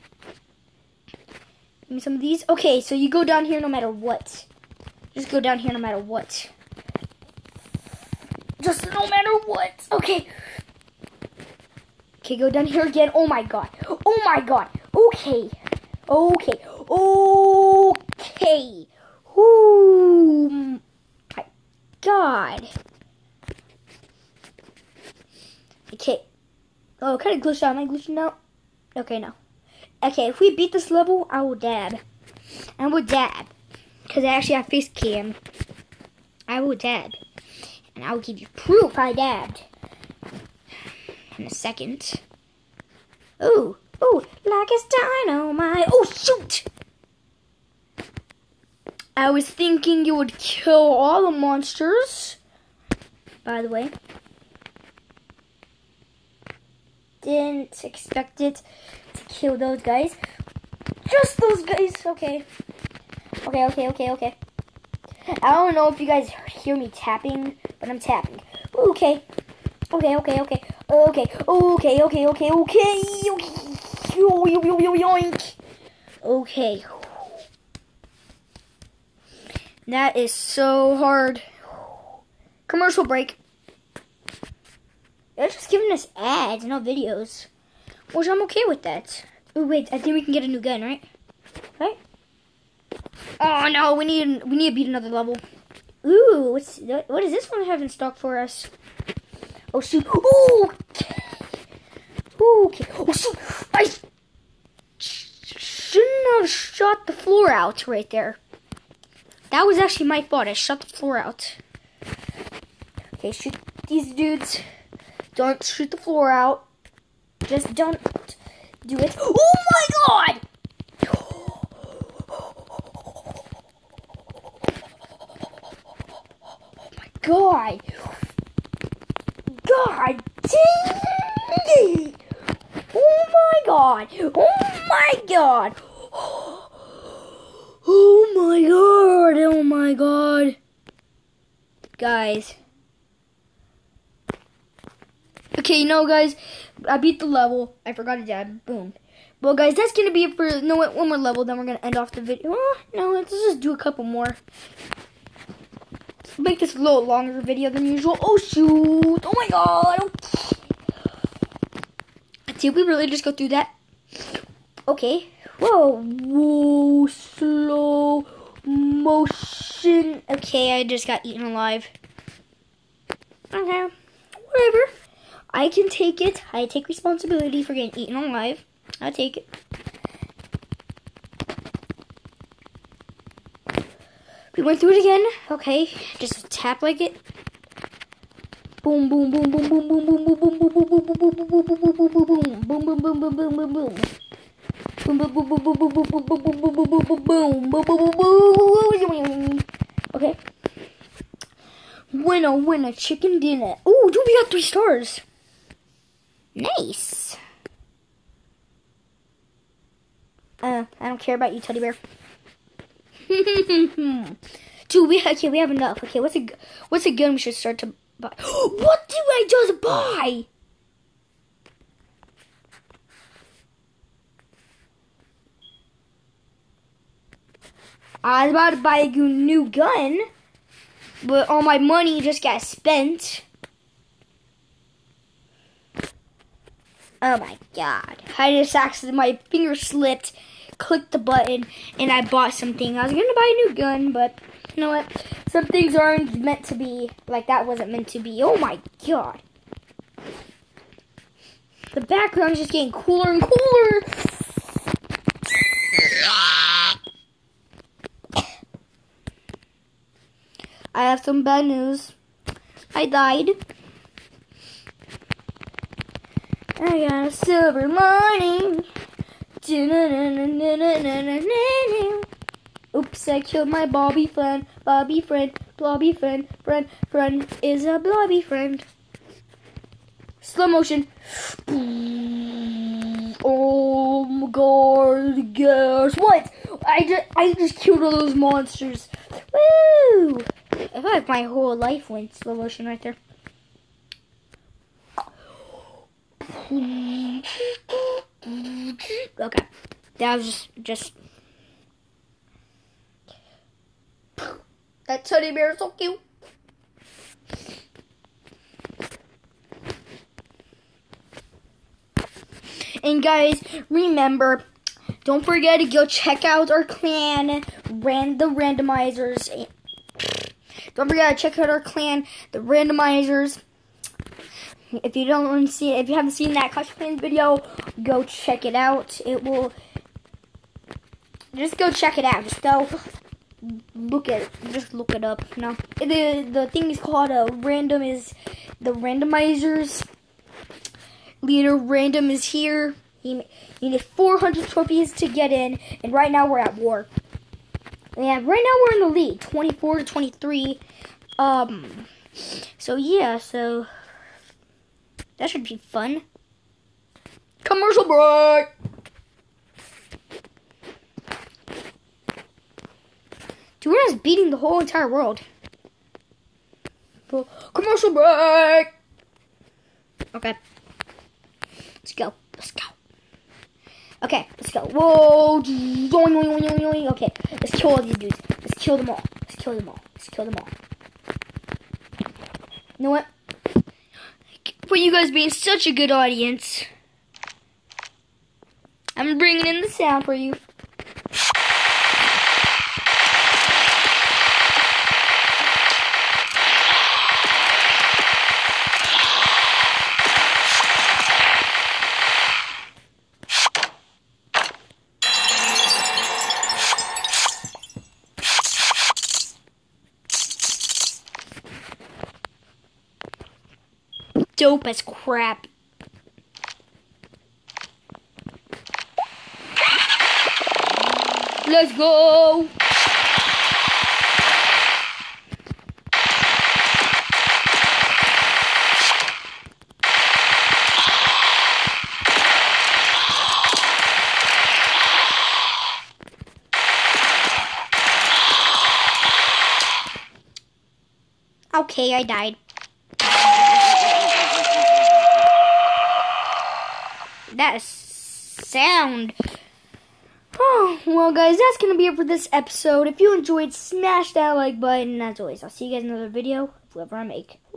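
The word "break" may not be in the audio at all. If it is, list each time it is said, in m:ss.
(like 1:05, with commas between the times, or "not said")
1:23, 5:58, 6:08.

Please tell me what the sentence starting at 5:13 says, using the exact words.
And guys, remember, don't forget to go check out our clan, ran the randomizers.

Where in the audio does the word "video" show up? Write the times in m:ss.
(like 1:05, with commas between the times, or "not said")
1:26, 2:32, 2:37, 5:27, 7:36.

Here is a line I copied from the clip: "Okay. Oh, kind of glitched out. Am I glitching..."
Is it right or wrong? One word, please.
right.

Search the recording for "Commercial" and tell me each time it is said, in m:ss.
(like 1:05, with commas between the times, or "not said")
1:22, 5:57, 6:07.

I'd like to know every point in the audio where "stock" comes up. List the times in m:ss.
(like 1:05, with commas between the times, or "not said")
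1:37.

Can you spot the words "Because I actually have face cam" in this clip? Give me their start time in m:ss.
0:34.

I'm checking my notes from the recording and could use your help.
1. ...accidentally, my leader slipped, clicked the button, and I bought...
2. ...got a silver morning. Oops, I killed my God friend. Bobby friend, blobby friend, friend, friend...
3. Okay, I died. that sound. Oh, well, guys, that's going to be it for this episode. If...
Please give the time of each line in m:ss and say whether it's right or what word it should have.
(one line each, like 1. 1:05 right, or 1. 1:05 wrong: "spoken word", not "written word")
1. 3:58 wrong: "finger", not "leader"
2. 4:27 wrong: "Bobby", not "God"
3. 7:21 right.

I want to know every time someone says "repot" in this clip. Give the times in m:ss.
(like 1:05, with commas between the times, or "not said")
not said.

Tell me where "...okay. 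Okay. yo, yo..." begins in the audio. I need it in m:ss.
1:12.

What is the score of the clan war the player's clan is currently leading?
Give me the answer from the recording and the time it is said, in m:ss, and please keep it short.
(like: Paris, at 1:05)
24 to 23, at 5:49.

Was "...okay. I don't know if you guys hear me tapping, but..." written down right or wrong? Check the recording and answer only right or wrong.
right.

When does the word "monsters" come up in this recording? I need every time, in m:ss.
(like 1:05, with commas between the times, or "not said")
0:51, 4:48.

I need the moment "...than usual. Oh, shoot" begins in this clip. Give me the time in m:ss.
2:37.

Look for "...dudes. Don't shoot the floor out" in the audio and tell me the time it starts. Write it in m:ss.
1:54.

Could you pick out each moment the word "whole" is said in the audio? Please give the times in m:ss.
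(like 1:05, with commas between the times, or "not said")
4:51, 6:04.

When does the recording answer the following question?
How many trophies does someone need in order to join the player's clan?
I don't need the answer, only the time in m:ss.
5:44.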